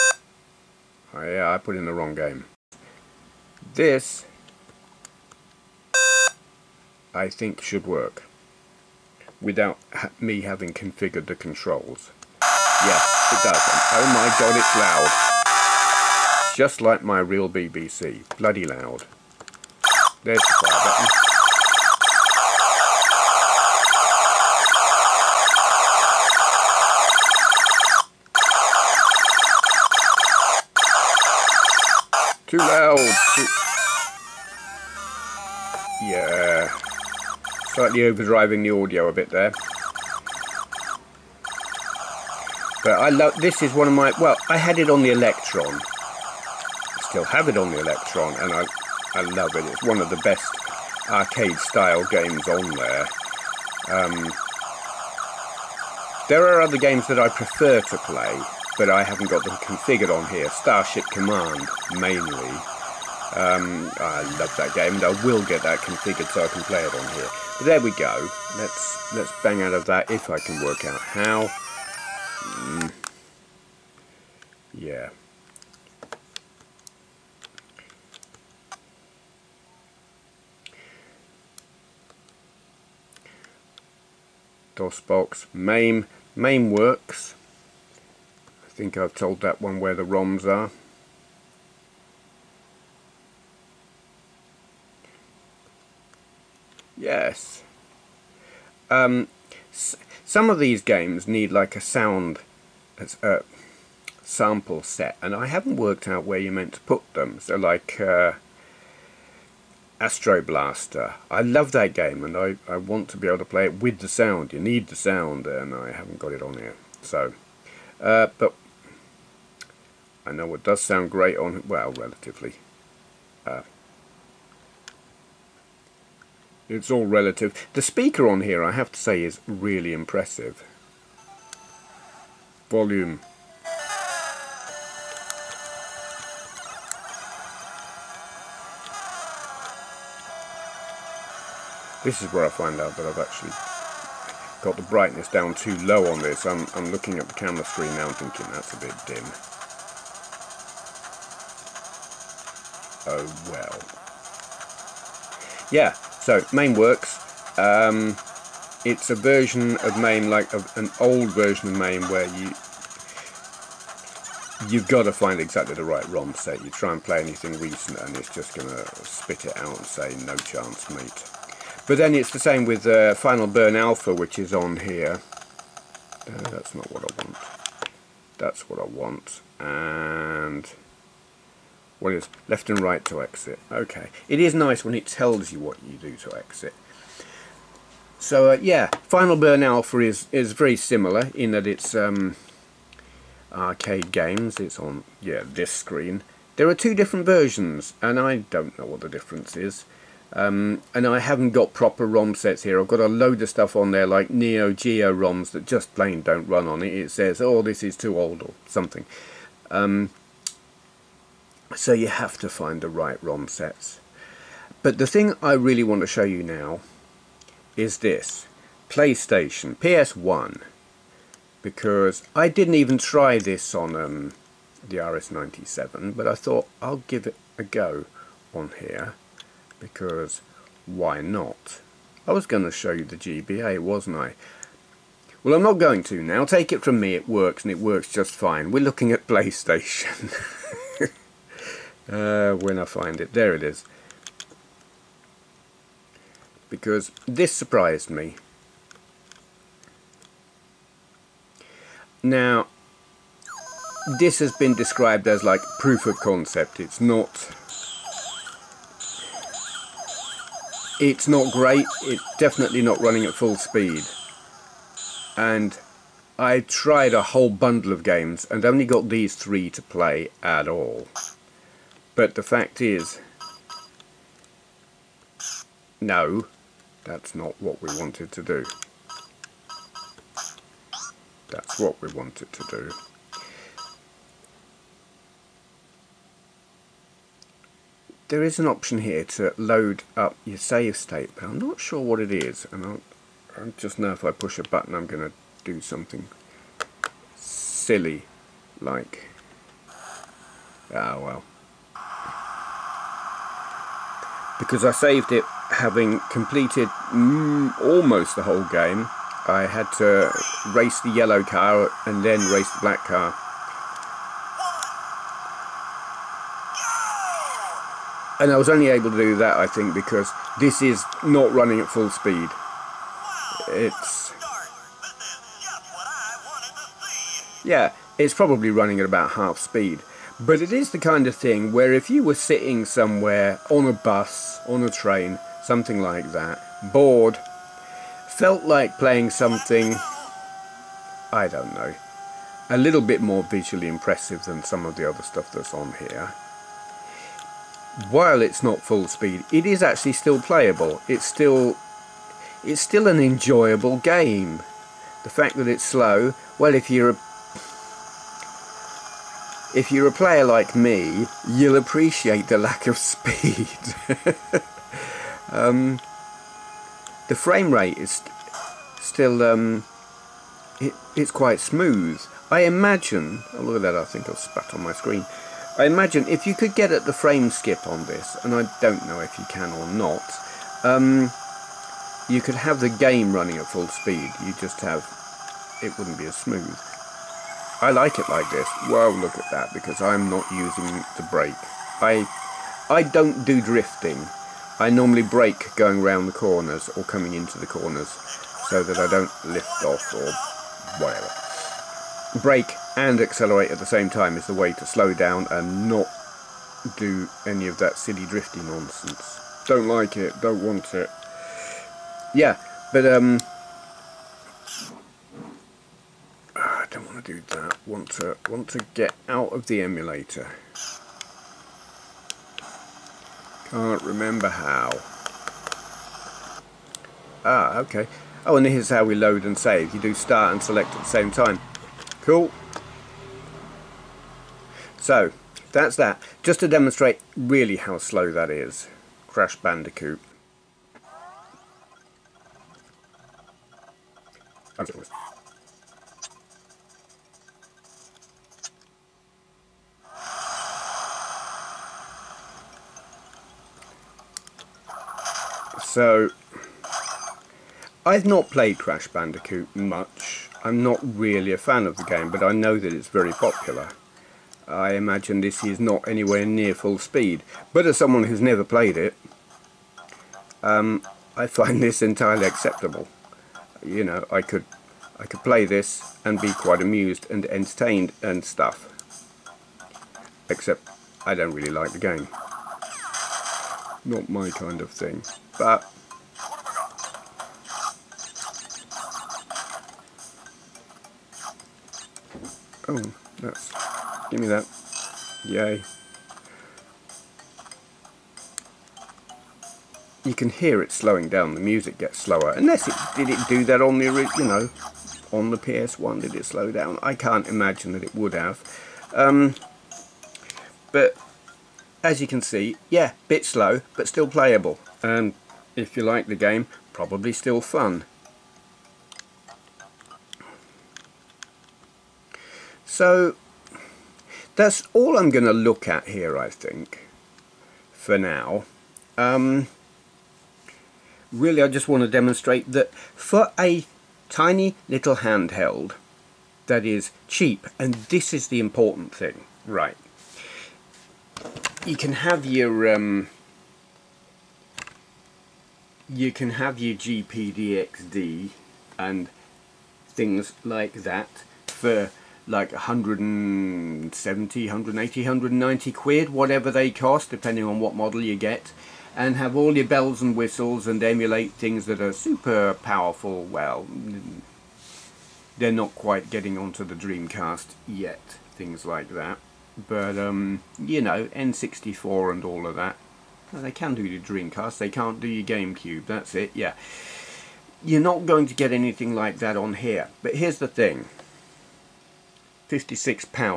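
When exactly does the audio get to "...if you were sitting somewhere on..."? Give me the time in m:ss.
5:31.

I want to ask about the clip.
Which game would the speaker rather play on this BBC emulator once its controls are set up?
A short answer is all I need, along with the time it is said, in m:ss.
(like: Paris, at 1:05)
Starship Command, at 1:00.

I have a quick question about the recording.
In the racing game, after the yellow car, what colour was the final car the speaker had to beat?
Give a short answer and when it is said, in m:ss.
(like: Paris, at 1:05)
Black, at 5:12.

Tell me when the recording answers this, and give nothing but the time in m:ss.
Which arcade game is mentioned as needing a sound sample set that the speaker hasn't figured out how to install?
1:49.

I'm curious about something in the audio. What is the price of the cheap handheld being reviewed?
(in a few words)
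£56.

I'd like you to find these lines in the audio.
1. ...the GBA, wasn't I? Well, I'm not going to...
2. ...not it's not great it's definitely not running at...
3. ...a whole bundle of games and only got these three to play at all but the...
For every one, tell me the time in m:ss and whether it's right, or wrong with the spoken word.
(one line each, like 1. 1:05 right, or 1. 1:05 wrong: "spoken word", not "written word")
1. 3:53 right
2. 4:16 right
3. 4:27 right.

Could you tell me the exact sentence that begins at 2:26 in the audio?
I'm, I'm looking at the camera screen now and thinking that's a bit dim.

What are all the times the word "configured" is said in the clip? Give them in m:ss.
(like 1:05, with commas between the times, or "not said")
0:10, 0:59, 1:05.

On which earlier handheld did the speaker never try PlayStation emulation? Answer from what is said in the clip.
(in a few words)
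RS-97.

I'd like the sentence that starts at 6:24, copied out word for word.
You just have it wouldn't be as smooth.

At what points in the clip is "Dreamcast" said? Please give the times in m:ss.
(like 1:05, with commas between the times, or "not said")
9:26, 9:34.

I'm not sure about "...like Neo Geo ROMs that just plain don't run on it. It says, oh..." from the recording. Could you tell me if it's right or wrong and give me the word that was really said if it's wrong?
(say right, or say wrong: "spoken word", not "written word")
right.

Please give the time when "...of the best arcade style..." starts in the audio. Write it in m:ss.
0:49.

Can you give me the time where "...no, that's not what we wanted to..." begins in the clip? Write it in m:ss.
4:35.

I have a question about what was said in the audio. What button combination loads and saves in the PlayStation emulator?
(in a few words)
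Start and select.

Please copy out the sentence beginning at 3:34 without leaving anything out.
But the thing I really want to show you now is this.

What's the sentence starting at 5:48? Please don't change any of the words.
While it's not full speed, it is actually still playable.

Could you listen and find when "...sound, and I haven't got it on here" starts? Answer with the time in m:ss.
1:54.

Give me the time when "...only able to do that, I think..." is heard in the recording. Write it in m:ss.
5:18.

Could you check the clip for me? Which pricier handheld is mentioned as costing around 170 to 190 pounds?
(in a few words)
GPD XD.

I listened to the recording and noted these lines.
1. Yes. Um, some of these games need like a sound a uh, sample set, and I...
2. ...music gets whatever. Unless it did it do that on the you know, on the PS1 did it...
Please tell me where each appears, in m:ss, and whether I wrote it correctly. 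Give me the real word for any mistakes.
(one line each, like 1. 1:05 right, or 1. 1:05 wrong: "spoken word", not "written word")
1. 1:36 right
2. 8:21 wrong: "slower", not "whatever".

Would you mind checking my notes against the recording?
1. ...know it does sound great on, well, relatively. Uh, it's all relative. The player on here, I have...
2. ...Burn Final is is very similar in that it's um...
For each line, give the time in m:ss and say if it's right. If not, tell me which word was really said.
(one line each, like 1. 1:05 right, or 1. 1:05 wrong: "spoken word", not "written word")
1. 2:00 wrong: "speaker", not "player"
2. 3:09 wrong: "Alpha", not "Final".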